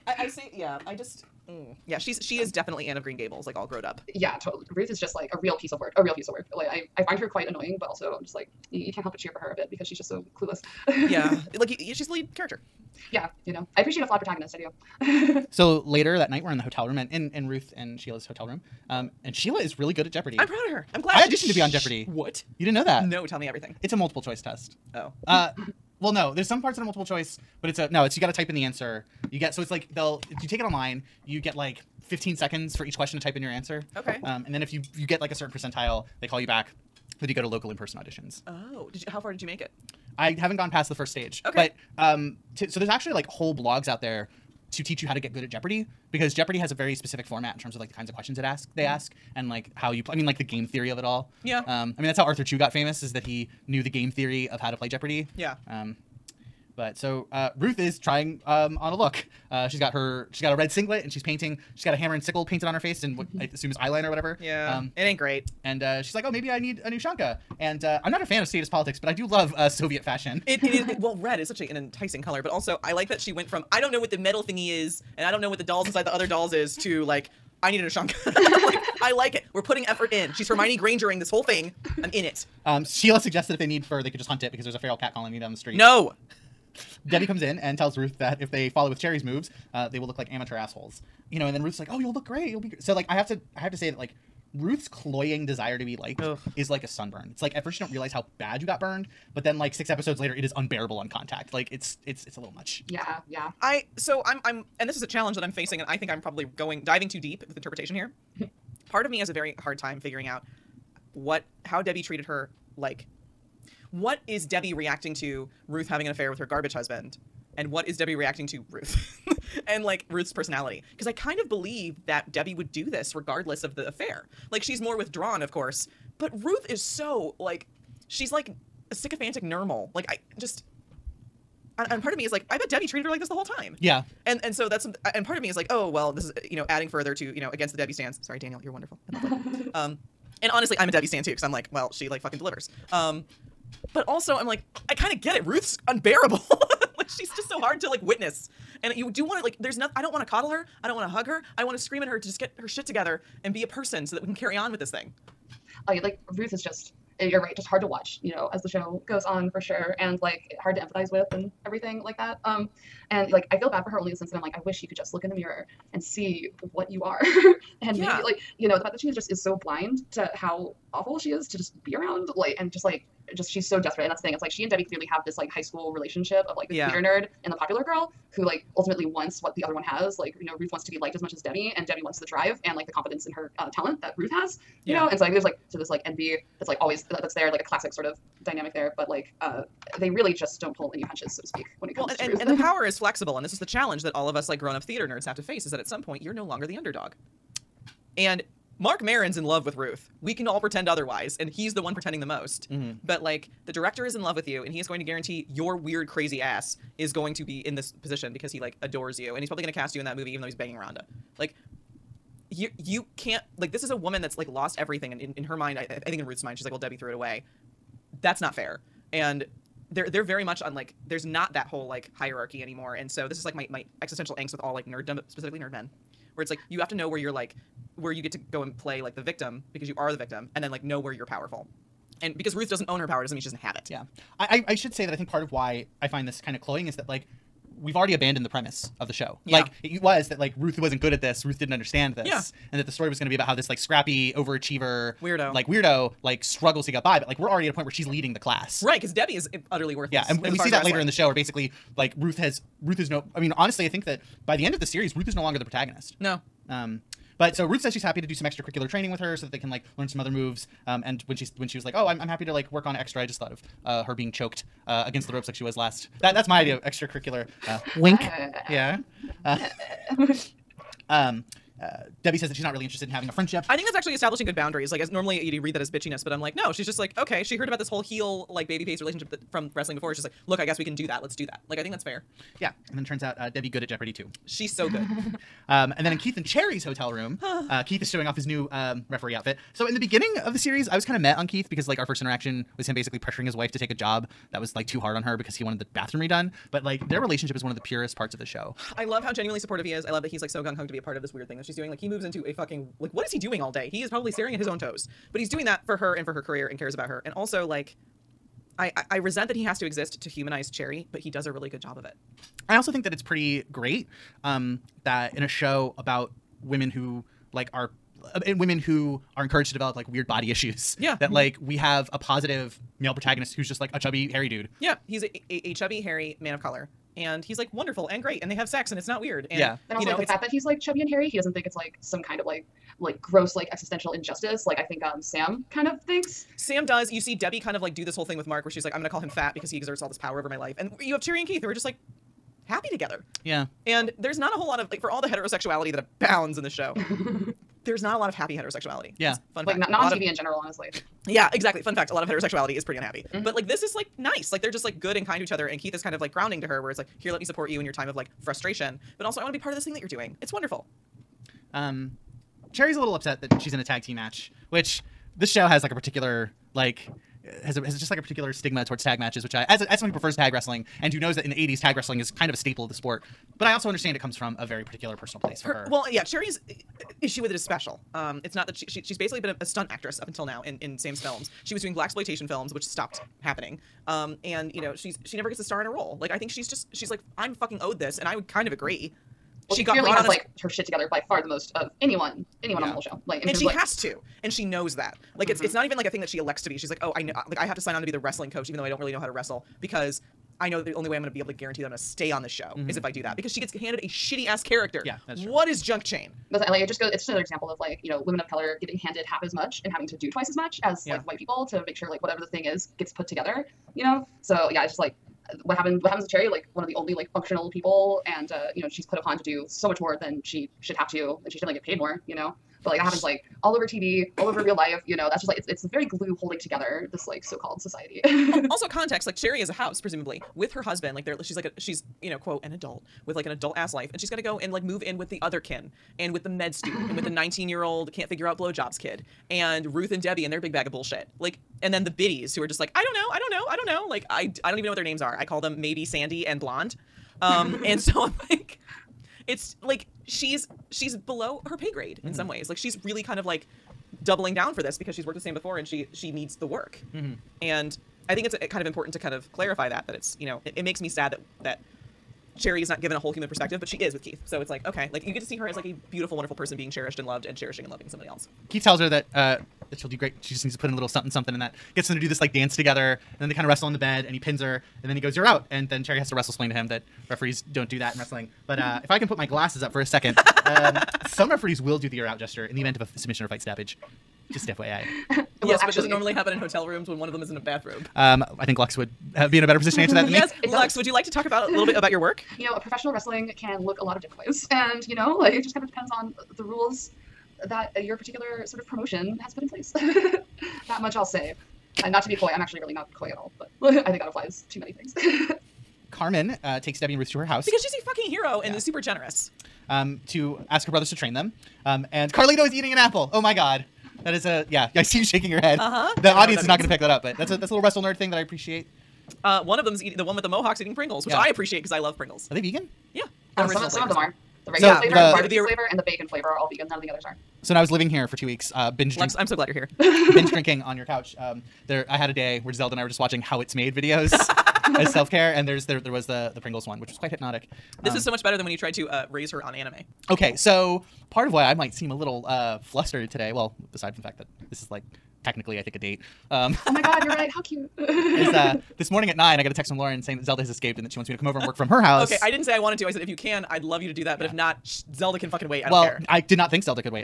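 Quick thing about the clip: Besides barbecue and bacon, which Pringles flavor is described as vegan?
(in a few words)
regular.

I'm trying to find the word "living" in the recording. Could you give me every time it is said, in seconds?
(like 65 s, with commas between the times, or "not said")
527 s.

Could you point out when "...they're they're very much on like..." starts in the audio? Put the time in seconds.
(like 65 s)
219 s.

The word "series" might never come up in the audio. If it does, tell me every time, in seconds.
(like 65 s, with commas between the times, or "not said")
254 s, 290 s.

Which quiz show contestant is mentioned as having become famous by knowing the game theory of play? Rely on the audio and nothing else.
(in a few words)
Arthur Chu.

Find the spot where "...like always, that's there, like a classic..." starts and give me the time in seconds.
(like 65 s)
186 s.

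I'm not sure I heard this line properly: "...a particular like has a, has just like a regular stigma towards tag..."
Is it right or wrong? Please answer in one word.
wrong.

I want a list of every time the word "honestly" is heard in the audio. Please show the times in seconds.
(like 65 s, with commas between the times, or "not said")
140 s, 253 s, 350 s.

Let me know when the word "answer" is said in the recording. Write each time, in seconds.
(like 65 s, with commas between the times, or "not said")
28 s, 33 s, 489 s.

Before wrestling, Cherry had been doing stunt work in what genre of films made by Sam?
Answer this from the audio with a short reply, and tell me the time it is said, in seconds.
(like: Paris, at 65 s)
blaxploitation films, at 381 s.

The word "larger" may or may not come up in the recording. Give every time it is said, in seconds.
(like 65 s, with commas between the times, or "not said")
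not said.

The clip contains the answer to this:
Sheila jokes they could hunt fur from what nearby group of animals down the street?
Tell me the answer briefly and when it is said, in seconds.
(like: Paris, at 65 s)
feral cat colony, at 84 s.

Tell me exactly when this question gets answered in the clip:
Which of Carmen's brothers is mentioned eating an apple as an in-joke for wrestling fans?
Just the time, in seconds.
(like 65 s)
512 s.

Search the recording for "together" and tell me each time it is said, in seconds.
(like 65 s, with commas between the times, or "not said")
152 s, 342 s, 390 s, 413 s, 426 s, 472 s.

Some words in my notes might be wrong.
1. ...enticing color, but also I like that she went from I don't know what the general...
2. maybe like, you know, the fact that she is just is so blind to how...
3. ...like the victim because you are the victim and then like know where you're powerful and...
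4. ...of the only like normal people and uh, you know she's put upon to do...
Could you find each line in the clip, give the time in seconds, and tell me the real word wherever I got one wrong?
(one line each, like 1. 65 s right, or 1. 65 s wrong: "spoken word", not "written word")
1. 71 s wrong: "metal", not "general"
2. 168 s right
3. 229 s right
4. 416 s wrong: "functional", not "normal".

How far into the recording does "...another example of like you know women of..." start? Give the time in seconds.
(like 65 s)
407 s.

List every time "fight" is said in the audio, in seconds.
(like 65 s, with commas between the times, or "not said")
483 s.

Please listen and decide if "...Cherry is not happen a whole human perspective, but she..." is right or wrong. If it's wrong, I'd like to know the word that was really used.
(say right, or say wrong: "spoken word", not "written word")
wrong: "given", not "happen".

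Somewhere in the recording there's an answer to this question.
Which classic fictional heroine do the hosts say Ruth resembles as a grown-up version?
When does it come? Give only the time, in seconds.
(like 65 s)
2 s.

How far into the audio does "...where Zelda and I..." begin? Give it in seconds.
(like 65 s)
532 s.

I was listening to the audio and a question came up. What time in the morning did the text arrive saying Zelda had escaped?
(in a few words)
9.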